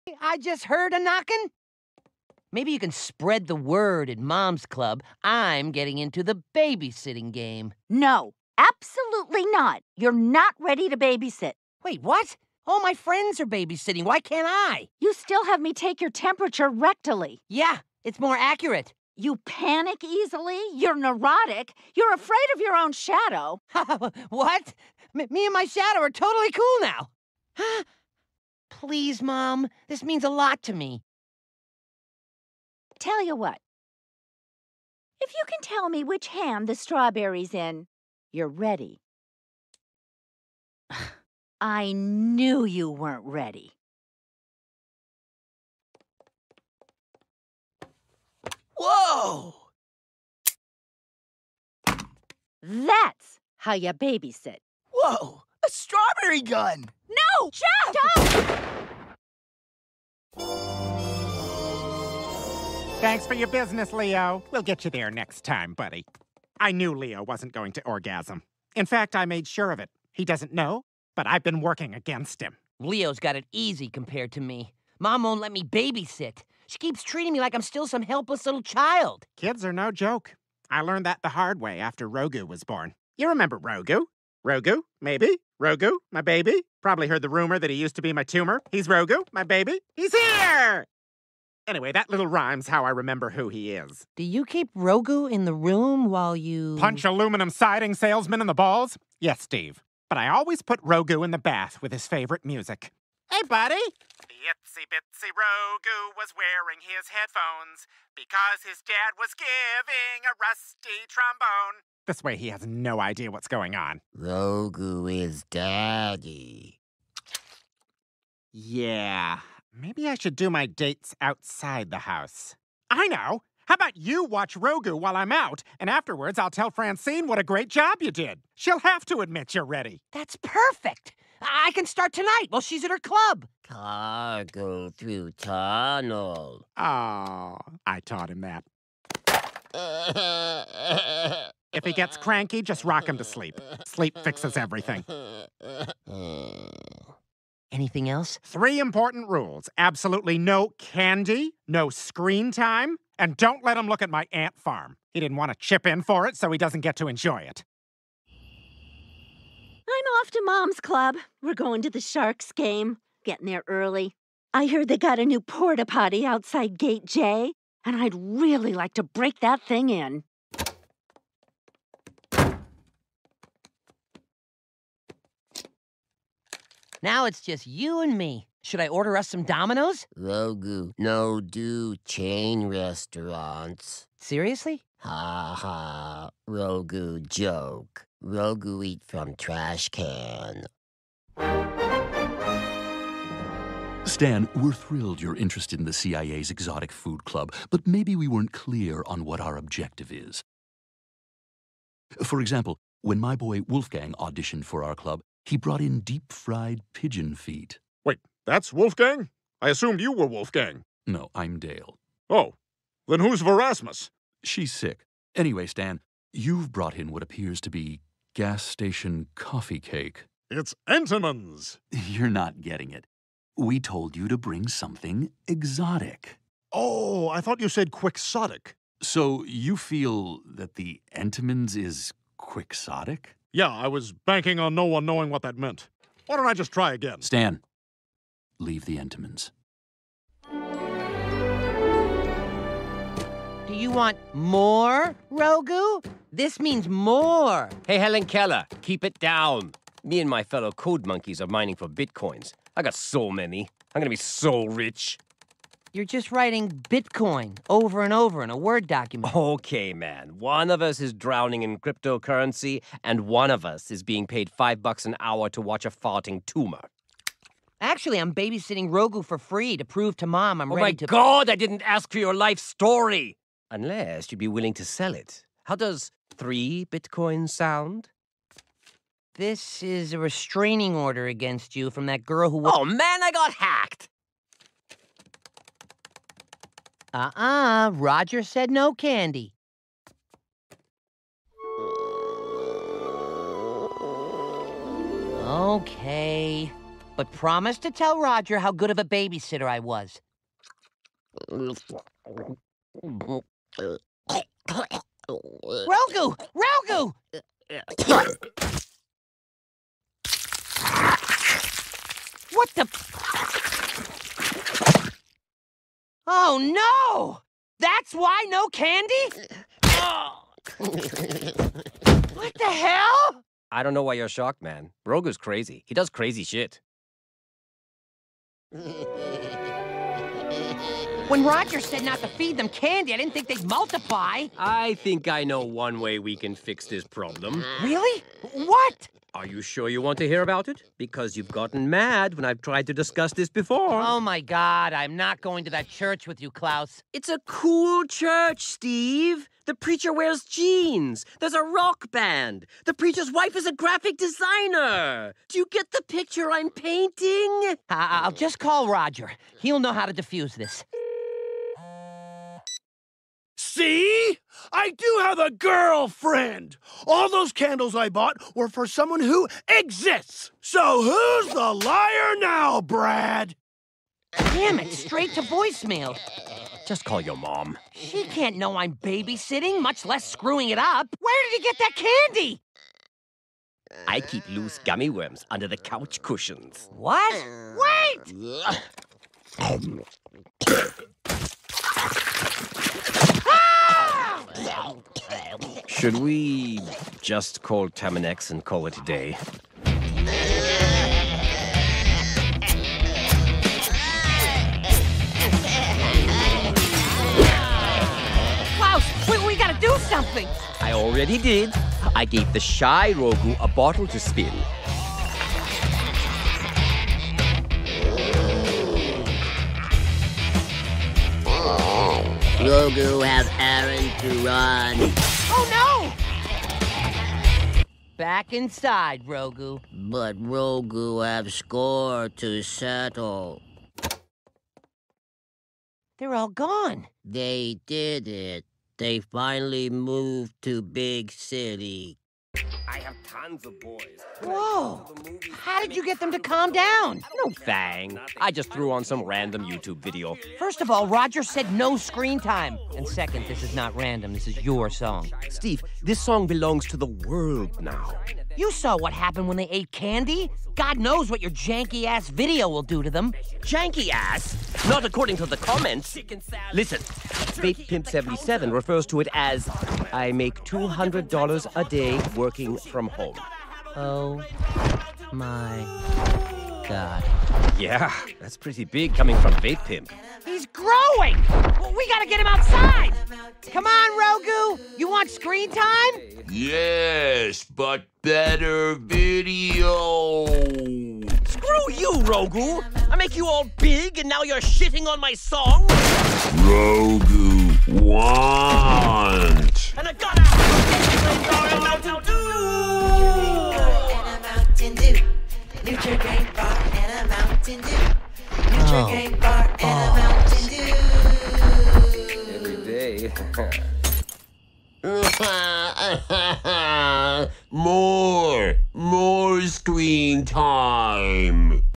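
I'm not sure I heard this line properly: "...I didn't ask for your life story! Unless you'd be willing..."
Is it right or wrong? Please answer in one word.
right.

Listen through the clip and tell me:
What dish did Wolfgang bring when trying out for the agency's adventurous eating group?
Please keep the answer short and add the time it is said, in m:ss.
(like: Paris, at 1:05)
Deep fried pigeon feet, at 3:26.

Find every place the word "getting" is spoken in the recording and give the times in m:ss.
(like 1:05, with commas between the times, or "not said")
0:05, 2:43, 3:42.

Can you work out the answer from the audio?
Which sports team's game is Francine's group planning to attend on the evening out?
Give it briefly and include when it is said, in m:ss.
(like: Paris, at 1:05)
Sharks, at 2:42.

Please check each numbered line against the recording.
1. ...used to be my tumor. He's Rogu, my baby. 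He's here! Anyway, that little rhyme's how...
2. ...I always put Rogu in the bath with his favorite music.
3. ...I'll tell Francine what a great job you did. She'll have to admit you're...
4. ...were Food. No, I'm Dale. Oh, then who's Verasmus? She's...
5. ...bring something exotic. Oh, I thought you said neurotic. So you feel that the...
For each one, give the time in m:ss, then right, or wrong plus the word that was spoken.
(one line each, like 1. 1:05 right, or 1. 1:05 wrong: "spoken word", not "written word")
1. 1:27 right
2. 1:40 right
3. 2:06 right
4. 3:30 wrong: "Wolfgang", not "Food"
5. 3:44 wrong: "quixotic", not "neurotic".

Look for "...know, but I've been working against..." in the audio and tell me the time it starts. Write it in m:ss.
1:10.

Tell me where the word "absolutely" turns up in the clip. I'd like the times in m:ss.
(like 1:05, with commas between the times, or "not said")
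0:08, 2:29.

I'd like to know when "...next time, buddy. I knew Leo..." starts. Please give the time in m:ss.
1:05.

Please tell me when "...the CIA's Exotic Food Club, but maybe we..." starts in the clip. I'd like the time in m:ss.
3:15.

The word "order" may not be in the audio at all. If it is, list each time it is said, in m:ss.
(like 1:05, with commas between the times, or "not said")
2:58, 4:40.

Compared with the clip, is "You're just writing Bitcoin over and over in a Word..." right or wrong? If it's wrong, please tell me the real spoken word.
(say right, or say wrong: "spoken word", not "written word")
right.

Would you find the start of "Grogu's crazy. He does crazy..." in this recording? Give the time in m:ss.
5:25.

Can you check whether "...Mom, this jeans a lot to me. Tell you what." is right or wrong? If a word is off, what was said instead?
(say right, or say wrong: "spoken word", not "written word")
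wrong: "means", not "jeans".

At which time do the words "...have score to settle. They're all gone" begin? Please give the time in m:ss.
7:11.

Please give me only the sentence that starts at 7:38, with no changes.
You saw what happened when they ate candy.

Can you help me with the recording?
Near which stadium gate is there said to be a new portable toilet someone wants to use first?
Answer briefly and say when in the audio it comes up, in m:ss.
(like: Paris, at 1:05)
Gate J, at 2:46.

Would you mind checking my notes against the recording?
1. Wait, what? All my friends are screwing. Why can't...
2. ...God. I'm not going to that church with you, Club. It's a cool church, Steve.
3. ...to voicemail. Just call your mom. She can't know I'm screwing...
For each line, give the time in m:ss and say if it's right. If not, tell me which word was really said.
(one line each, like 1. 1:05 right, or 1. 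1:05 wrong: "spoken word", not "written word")
1. 0:11 wrong: "babysitting", not "screwing"
2. 5:44 wrong: "Klaus", not "Club"
3. 6:15 wrong: "babysitting", not "screwing".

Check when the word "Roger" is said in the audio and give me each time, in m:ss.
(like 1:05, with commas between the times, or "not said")
4:47, 4:58, 5:31, 5:58, 7:31.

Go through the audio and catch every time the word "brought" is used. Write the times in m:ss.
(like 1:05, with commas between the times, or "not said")
3:25, 3:36.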